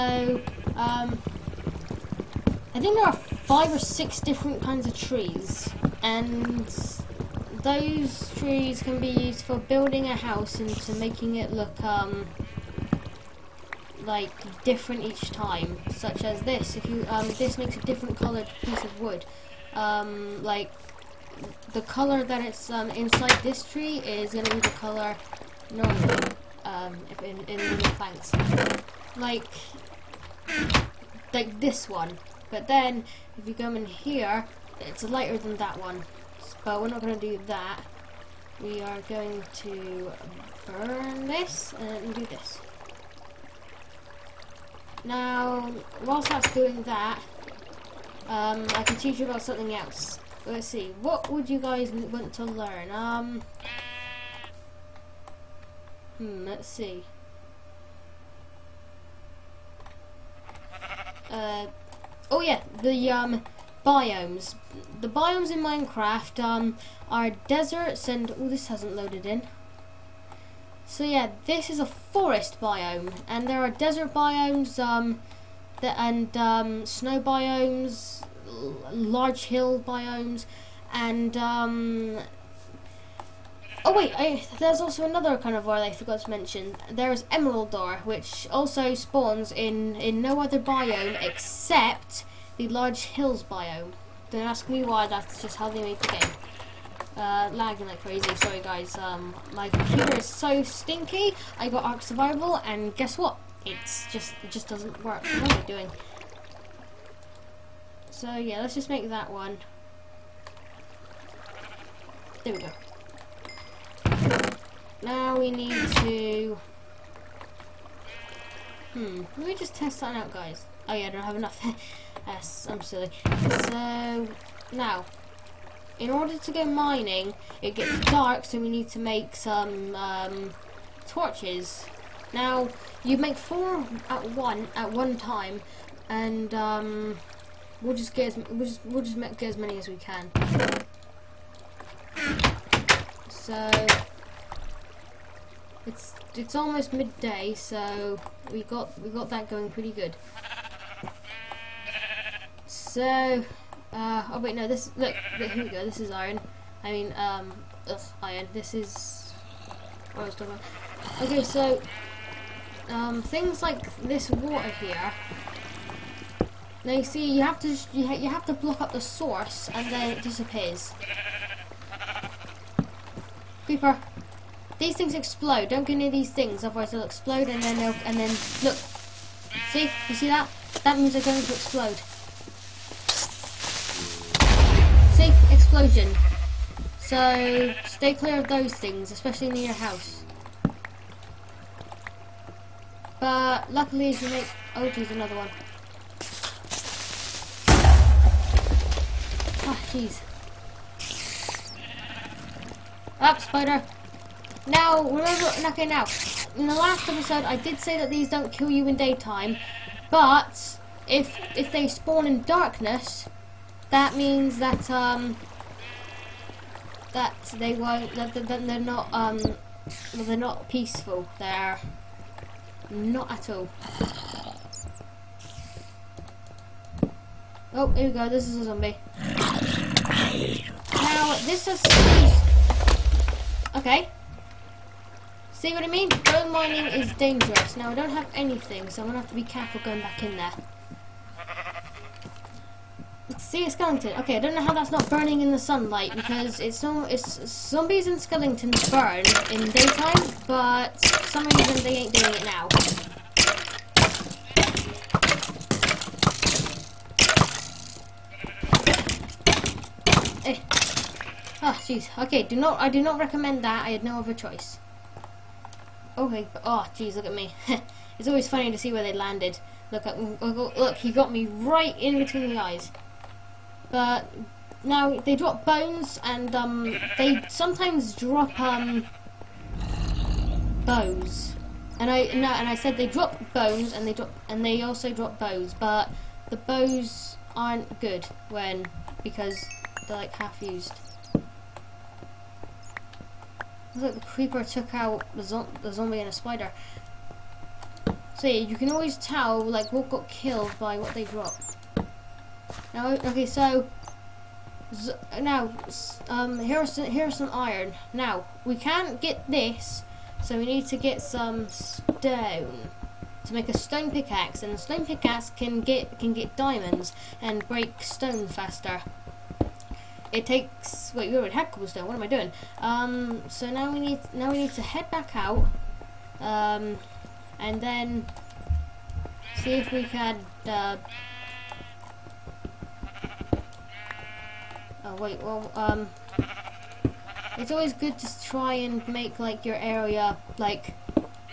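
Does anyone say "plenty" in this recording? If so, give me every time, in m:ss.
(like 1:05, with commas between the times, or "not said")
not said.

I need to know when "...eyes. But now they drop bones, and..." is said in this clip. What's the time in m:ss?
4:32.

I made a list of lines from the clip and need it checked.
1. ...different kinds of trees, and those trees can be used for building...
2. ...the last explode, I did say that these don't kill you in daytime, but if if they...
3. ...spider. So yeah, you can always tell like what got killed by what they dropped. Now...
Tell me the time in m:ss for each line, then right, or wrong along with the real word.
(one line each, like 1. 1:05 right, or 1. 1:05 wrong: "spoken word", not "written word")
1. 0:04 right
2. 3:26 wrong: "episode", not "explode"
3. 4:56 right.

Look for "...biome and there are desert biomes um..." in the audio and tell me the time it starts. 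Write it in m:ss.
1:12.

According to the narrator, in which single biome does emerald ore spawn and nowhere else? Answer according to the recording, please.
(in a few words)
Large hills biome.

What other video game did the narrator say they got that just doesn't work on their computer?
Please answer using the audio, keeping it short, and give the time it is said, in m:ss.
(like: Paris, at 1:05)
Ark Survival, at 1:41.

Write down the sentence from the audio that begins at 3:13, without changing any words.
But luckily, as you make oh, geez, another one.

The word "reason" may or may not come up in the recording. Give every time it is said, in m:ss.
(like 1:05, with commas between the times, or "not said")
4:11.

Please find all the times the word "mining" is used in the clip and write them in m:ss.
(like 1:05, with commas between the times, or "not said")
2:06, 3:56.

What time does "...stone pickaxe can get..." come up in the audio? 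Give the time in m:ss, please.
5:14.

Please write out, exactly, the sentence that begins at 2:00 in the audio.
Oh yeah, I don't have enough.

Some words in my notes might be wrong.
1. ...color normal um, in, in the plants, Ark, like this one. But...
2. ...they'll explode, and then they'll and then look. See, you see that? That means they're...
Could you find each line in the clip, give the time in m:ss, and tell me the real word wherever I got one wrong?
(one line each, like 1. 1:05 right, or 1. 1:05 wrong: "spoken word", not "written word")
1. 0:24 wrong: "Like", not "Ark"
2. 2:56 right.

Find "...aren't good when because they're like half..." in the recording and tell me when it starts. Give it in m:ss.
4:47.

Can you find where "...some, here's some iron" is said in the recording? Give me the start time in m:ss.
5:06.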